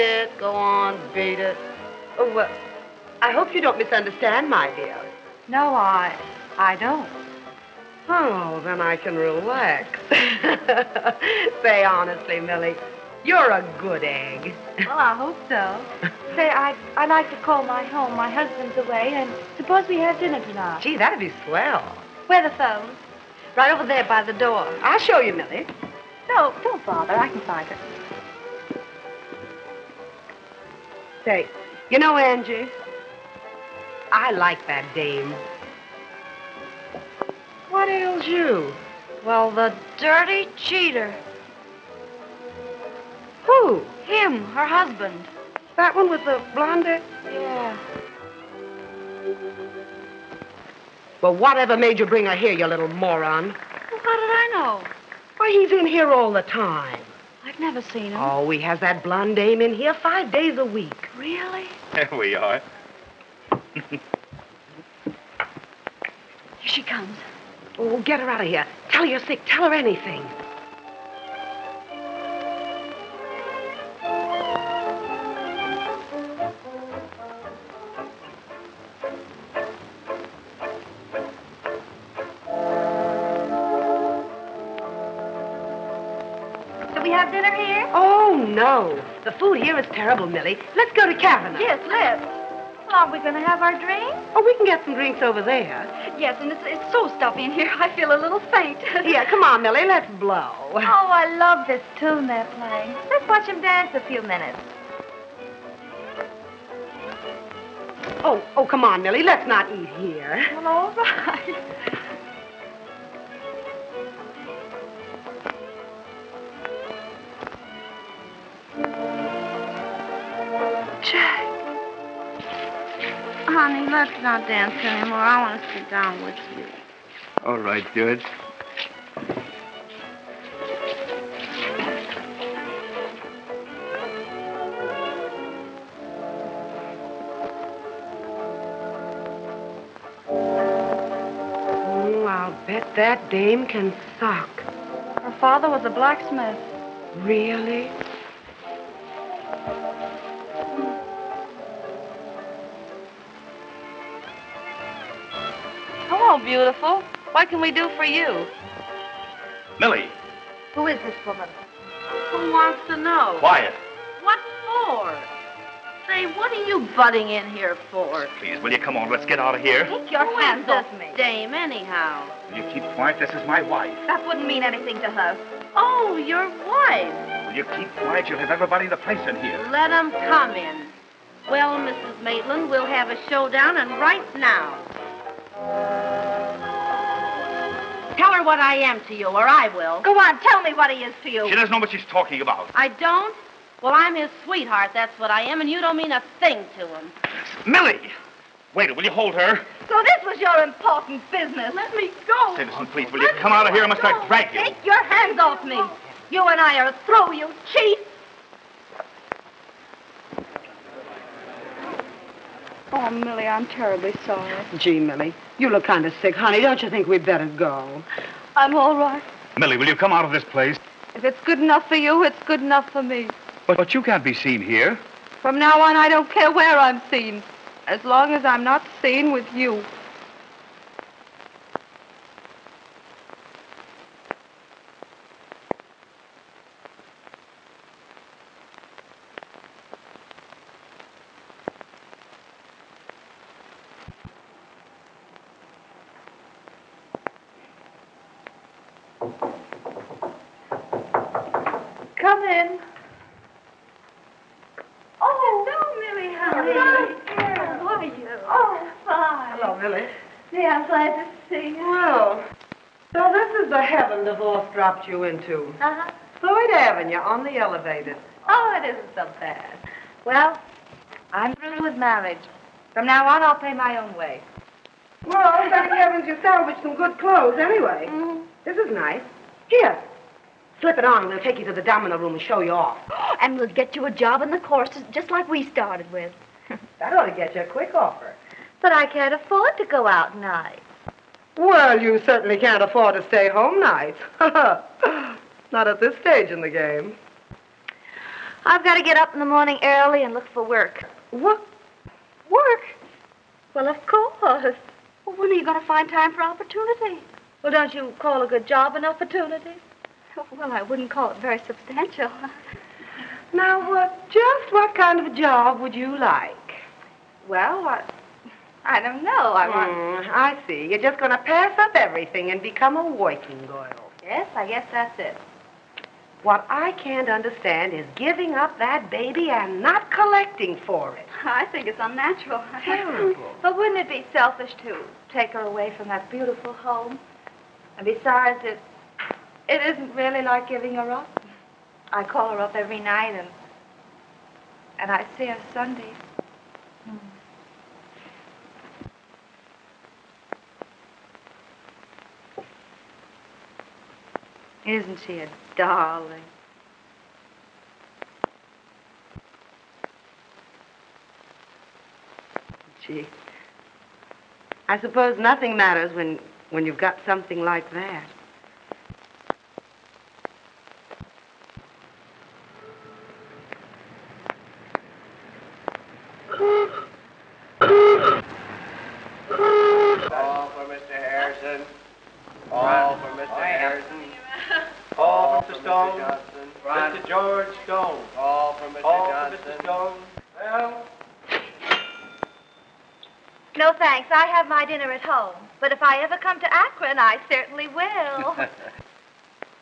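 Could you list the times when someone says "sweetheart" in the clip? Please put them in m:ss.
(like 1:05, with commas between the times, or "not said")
3:14.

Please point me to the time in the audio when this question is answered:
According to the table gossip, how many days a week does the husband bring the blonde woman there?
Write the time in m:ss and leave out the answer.
0:59.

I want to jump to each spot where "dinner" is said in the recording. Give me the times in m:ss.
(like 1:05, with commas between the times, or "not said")
0:20, 6:34.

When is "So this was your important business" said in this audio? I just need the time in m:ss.
3:19.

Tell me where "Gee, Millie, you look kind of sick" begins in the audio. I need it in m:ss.
3:34.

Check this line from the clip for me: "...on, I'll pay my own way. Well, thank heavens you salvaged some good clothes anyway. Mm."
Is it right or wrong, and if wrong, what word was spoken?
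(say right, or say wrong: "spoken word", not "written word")
right.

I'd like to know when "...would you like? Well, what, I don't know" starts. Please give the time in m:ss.
5:15.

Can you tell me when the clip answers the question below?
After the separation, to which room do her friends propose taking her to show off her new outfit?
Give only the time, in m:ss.
4:41.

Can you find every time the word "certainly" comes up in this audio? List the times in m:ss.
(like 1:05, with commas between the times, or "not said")
4:52, 6:37.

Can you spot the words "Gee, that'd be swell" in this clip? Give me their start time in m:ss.
0:20.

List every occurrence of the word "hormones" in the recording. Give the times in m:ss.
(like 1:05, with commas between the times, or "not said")
not said.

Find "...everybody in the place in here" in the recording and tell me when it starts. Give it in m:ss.
2:58.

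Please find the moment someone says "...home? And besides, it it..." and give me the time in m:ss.
5:36.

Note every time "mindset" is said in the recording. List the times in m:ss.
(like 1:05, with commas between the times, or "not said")
not said.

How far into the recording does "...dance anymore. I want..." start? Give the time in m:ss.
2:04.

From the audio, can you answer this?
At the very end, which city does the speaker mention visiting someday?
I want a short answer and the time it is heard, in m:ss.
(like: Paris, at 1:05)
Akron, at 6:36.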